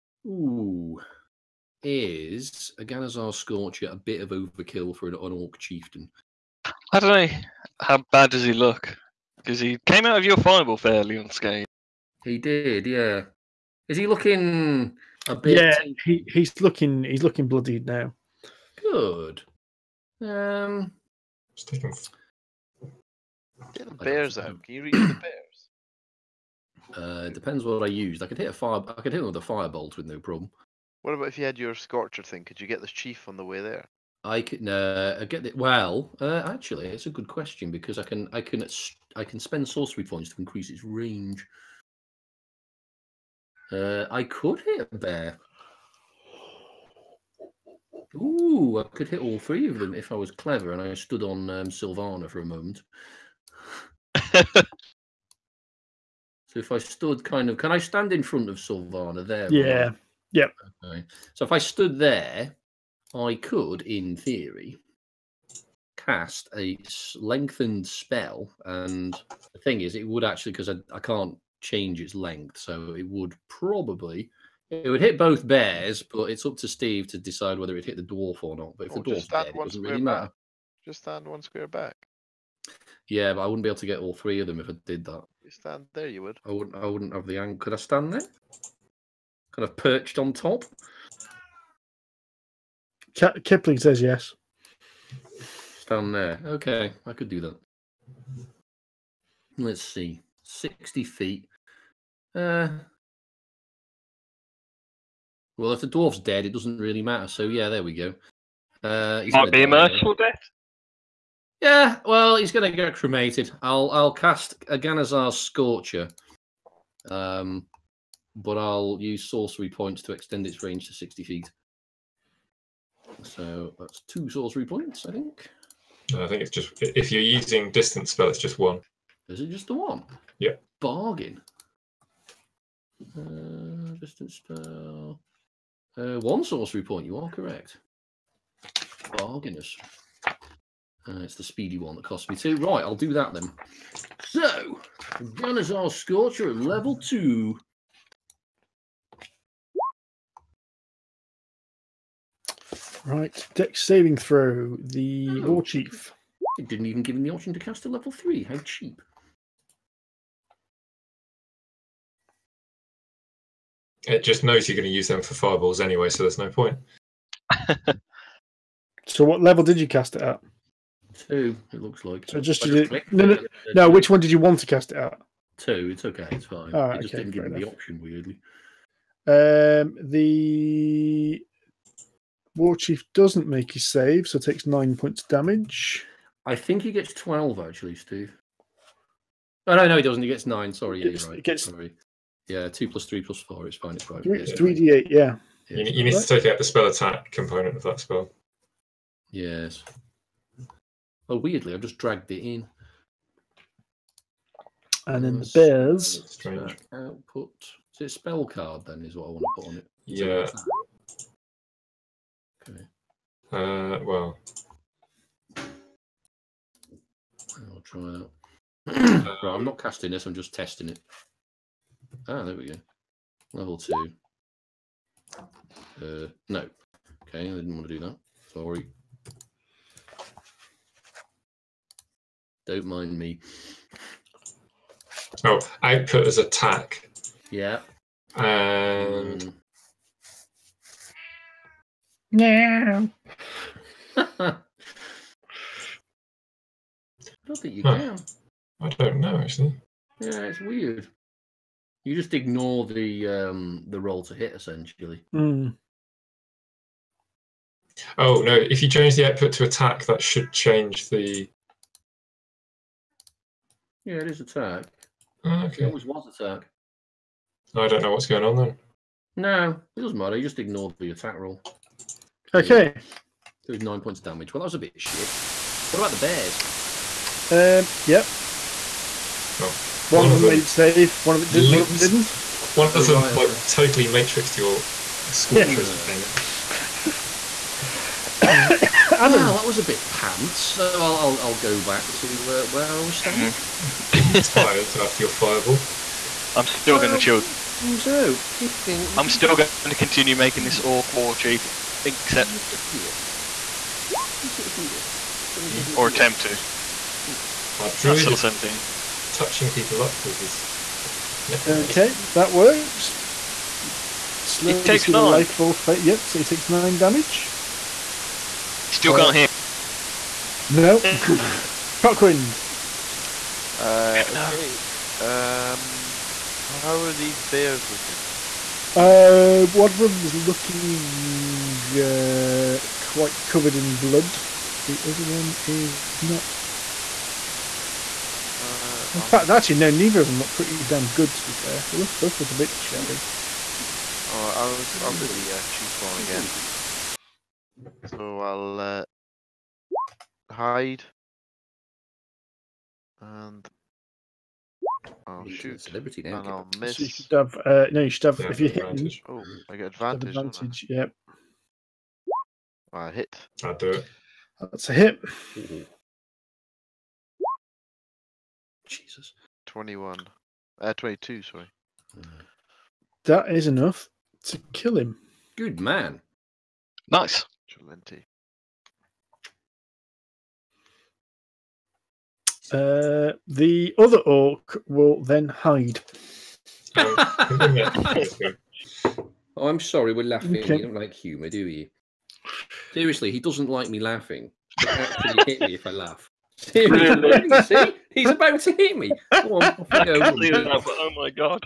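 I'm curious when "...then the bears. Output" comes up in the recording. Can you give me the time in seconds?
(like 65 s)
205 s.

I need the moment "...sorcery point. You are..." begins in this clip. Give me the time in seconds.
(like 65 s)
136 s.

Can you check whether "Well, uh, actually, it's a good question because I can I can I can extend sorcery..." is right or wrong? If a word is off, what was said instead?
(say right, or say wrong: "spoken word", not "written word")
wrong: "spend", not "extend".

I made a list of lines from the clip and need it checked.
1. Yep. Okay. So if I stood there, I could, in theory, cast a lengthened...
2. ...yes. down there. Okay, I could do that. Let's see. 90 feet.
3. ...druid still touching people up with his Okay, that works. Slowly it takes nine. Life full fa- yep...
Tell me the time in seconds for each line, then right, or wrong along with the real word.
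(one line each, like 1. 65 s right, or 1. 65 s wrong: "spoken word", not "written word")
1. 60 s right
2. 94 s wrong: "60", not "90"
3. 307 s right.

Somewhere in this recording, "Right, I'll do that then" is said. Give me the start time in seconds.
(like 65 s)
142 s.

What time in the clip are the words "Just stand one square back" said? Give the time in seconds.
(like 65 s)
80 s.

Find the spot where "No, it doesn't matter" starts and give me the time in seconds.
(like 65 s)
269 s.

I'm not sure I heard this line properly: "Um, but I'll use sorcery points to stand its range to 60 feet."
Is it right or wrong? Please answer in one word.
wrong.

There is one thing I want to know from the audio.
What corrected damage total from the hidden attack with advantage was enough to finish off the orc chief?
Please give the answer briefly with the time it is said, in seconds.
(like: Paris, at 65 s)
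22, at 370 s.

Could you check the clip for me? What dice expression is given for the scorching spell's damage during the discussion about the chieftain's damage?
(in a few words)
3d8.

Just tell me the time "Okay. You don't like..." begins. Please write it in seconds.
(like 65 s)
390 s.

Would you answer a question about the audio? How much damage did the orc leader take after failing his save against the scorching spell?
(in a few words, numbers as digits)
9.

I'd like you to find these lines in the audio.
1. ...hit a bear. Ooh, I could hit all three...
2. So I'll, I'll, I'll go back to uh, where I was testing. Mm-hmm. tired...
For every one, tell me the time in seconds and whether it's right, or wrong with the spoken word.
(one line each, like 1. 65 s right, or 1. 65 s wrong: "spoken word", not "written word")
1. 44 s right
2. 290 s wrong: "standing", not "testing".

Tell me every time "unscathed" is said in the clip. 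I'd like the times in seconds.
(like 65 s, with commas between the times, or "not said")
11 s.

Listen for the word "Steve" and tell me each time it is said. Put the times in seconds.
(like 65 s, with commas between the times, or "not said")
76 s, 187 s.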